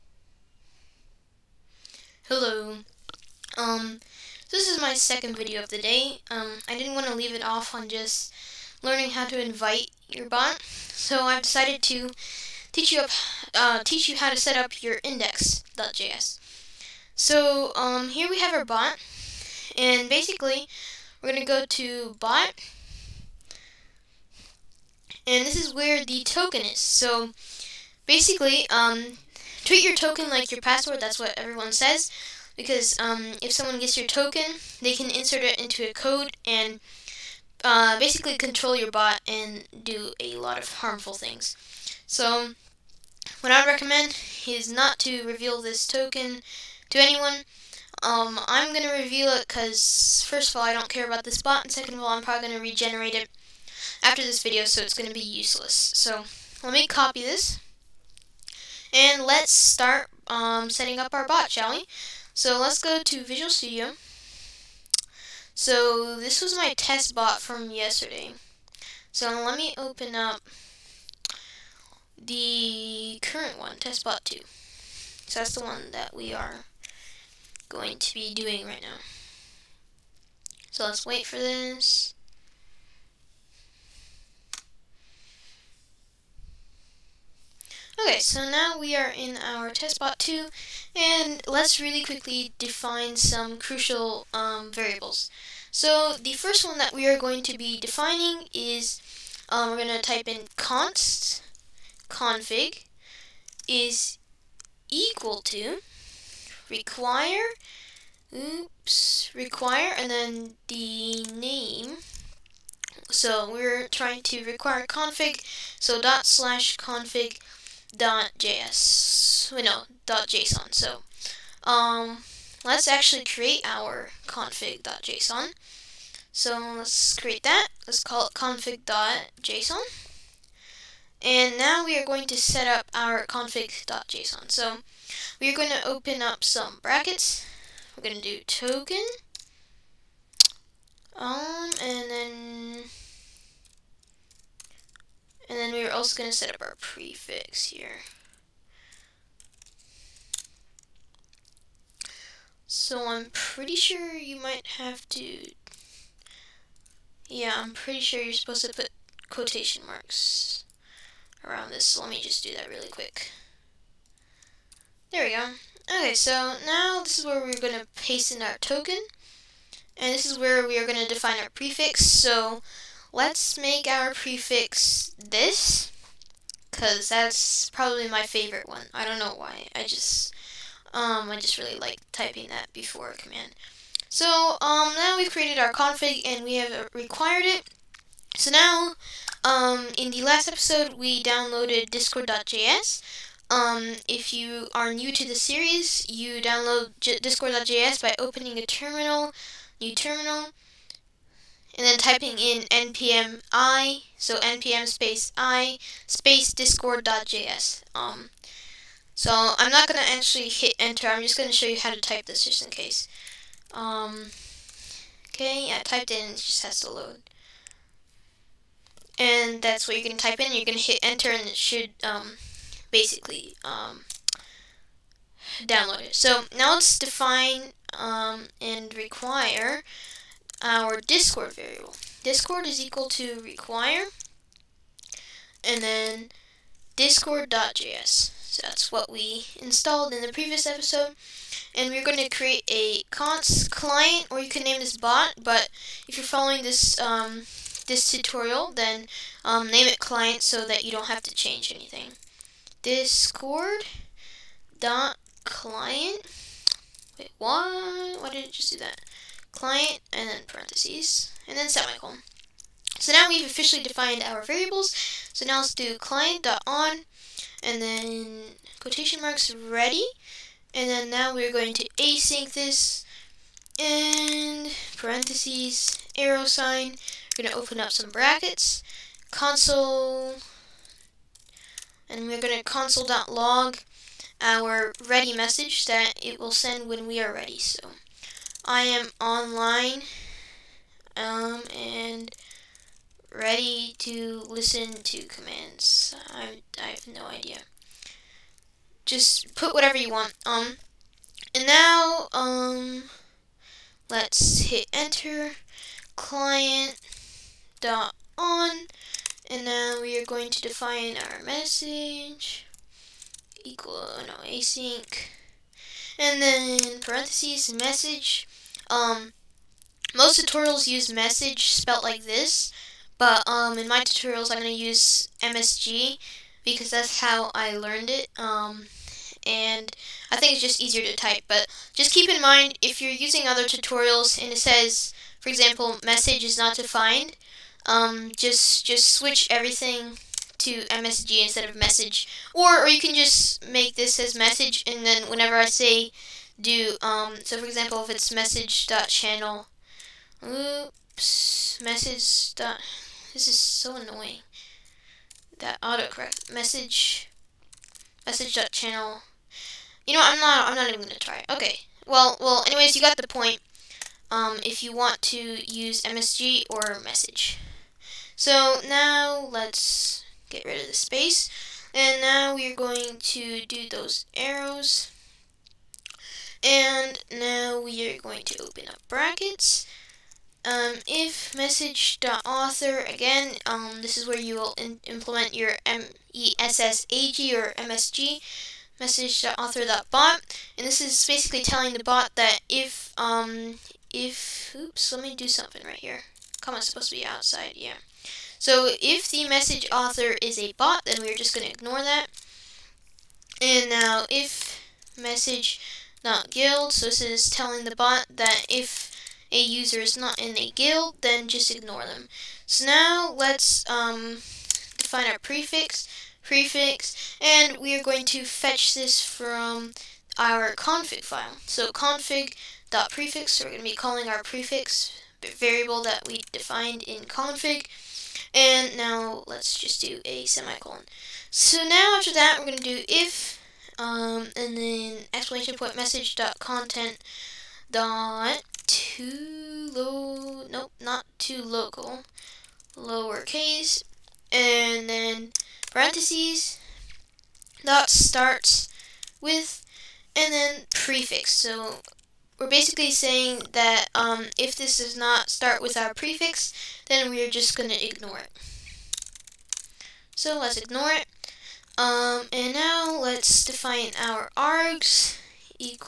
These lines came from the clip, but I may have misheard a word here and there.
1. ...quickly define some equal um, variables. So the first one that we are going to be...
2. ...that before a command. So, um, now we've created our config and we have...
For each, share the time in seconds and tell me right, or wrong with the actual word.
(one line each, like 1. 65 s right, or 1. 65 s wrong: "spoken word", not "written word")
1. 92 s wrong: "crucial", not "equal"
2. 182 s right.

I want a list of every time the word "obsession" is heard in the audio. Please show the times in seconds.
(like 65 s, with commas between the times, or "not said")
not said.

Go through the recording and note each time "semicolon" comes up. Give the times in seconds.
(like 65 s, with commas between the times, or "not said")
261 s, 430 s.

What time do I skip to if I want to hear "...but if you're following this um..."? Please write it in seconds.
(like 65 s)
245 s.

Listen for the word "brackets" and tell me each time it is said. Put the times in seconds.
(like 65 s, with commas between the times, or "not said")
136 s, 278 s, 379 s.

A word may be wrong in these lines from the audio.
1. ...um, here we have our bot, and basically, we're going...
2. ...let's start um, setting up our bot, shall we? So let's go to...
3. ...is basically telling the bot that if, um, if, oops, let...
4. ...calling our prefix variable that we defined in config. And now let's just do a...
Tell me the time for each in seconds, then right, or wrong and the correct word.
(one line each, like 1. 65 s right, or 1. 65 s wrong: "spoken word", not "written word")
1. 17 s right
2. 59 s right
3. 390 s right
4. 423 s right.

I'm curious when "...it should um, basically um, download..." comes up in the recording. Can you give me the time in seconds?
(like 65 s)
221 s.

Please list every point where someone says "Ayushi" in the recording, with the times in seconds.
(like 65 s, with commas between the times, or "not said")
not said.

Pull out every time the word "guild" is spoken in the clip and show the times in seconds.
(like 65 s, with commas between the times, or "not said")
406 s, 410 s.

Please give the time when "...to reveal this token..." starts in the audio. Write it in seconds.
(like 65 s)
44 s.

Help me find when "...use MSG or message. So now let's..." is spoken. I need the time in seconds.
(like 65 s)
365 s.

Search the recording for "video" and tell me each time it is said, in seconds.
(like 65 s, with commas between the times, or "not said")
5 s, 54 s.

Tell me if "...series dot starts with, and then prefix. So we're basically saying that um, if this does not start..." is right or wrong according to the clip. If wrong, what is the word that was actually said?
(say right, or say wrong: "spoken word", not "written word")
wrong: "parentheses", not "series".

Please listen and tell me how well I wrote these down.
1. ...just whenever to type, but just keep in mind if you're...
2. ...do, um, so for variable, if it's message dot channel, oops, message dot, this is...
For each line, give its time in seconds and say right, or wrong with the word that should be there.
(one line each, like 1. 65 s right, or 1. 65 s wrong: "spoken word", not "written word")
1. 330 s wrong: "easier", not "whenever"
2. 346 s wrong: "example", not "variable".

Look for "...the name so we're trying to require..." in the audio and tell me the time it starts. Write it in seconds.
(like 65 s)
110 s.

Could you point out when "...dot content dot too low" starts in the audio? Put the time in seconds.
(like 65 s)
436 s.